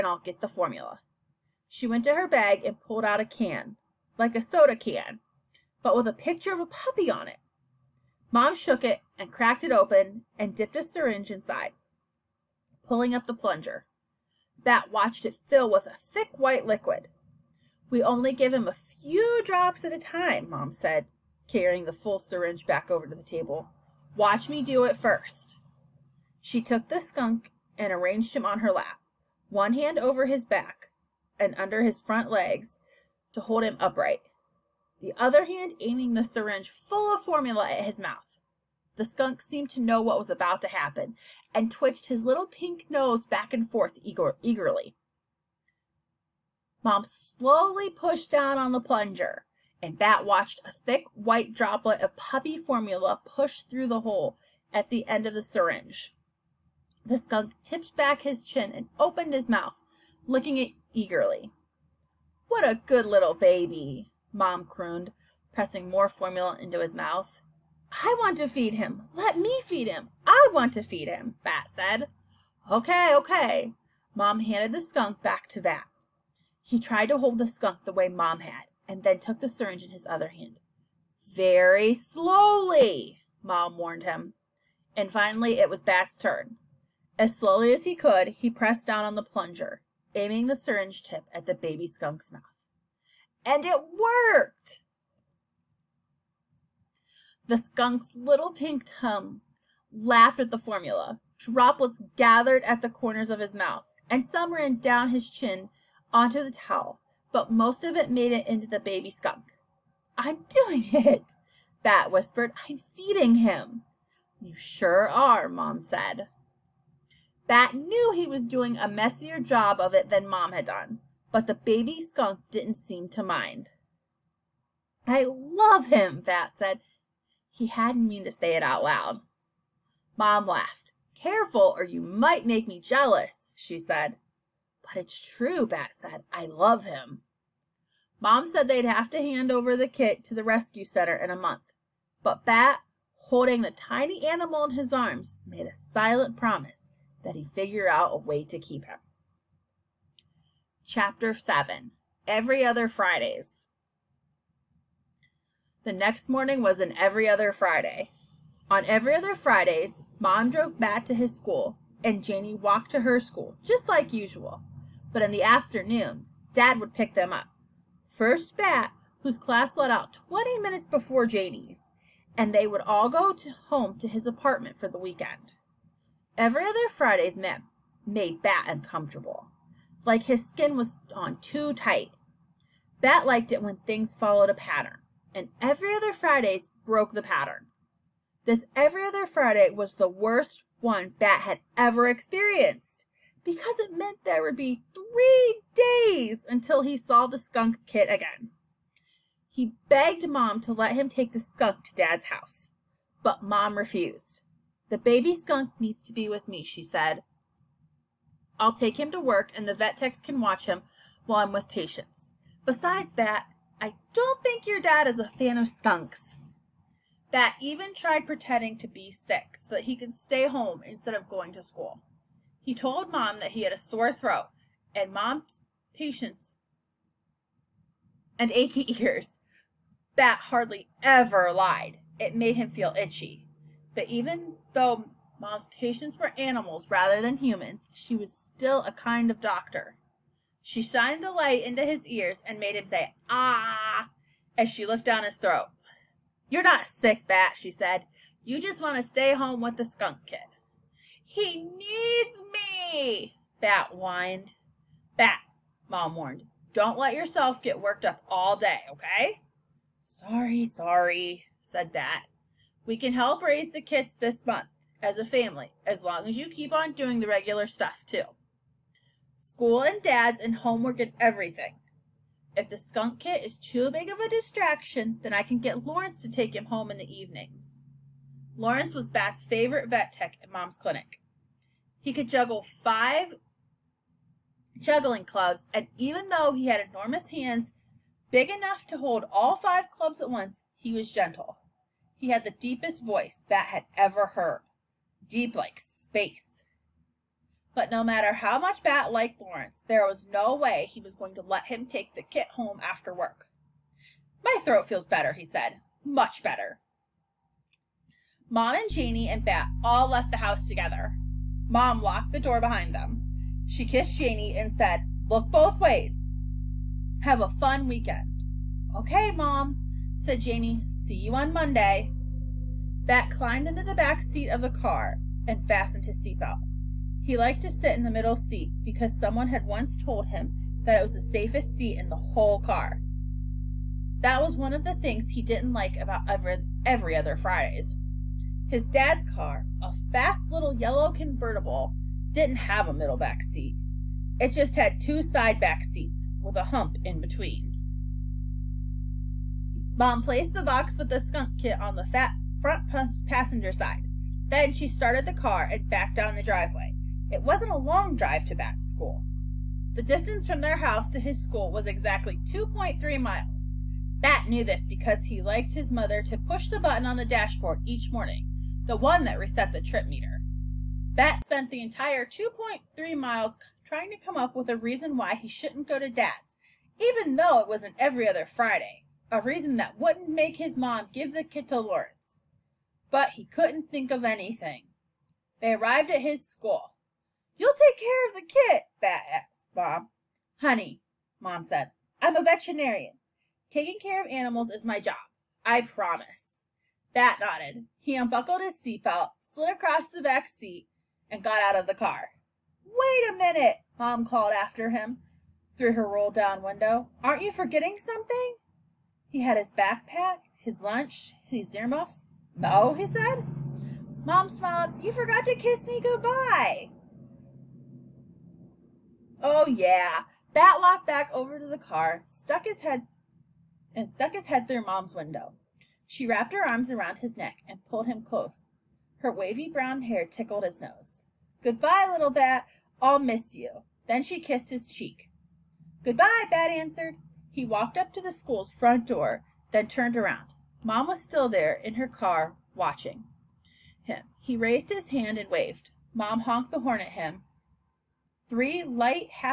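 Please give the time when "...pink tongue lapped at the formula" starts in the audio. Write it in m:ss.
1:38.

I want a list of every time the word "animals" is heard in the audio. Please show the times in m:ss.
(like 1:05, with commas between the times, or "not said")
2:24, 3:56, 6:34.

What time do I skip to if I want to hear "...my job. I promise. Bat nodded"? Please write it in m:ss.
6:34.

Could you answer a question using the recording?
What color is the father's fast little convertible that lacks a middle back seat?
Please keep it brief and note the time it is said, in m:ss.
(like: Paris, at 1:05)
Yellow, at 5:40.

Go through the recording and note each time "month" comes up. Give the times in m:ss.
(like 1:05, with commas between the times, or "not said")
2:21, 4:24.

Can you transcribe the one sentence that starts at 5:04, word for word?
My throat feels better, he said.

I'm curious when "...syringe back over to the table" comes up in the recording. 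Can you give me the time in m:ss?
0:22.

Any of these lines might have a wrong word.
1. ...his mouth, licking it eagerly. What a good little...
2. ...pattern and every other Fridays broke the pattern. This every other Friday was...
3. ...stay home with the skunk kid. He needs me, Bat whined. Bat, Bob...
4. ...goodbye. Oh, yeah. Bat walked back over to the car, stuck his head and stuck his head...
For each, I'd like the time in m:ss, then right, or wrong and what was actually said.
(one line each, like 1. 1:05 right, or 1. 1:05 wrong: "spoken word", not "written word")
1. 0:59 right
2. 3:04 right
3. 4:09 wrong: "Mom", not "Bob"
4. 6:56 right.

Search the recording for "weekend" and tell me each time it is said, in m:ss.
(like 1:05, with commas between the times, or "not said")
2:54, 5:17.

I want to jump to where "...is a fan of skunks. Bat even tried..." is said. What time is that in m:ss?
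3:35.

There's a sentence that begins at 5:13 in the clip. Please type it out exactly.
She kissed Janie and said, Look both ways.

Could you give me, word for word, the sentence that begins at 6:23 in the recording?
But he couldn't think of anything.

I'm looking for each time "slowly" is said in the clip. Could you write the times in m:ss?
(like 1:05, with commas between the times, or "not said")
0:47, 1:21, 1:27.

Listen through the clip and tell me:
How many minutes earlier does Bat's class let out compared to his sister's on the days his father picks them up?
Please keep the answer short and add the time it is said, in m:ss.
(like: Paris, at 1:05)
20, at 2:50.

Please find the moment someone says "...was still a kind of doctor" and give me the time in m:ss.
3:58.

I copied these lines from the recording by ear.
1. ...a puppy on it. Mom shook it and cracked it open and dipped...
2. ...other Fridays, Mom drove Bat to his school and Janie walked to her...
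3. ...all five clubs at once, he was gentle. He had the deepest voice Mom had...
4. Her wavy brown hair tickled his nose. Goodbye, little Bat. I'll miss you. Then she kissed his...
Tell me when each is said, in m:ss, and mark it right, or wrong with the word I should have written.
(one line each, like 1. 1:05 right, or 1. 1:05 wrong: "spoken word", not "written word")
1. 0:06 right
2. 2:39 right
3. 4:49 wrong: "Bat", not "Mom"
4. 7:09 right.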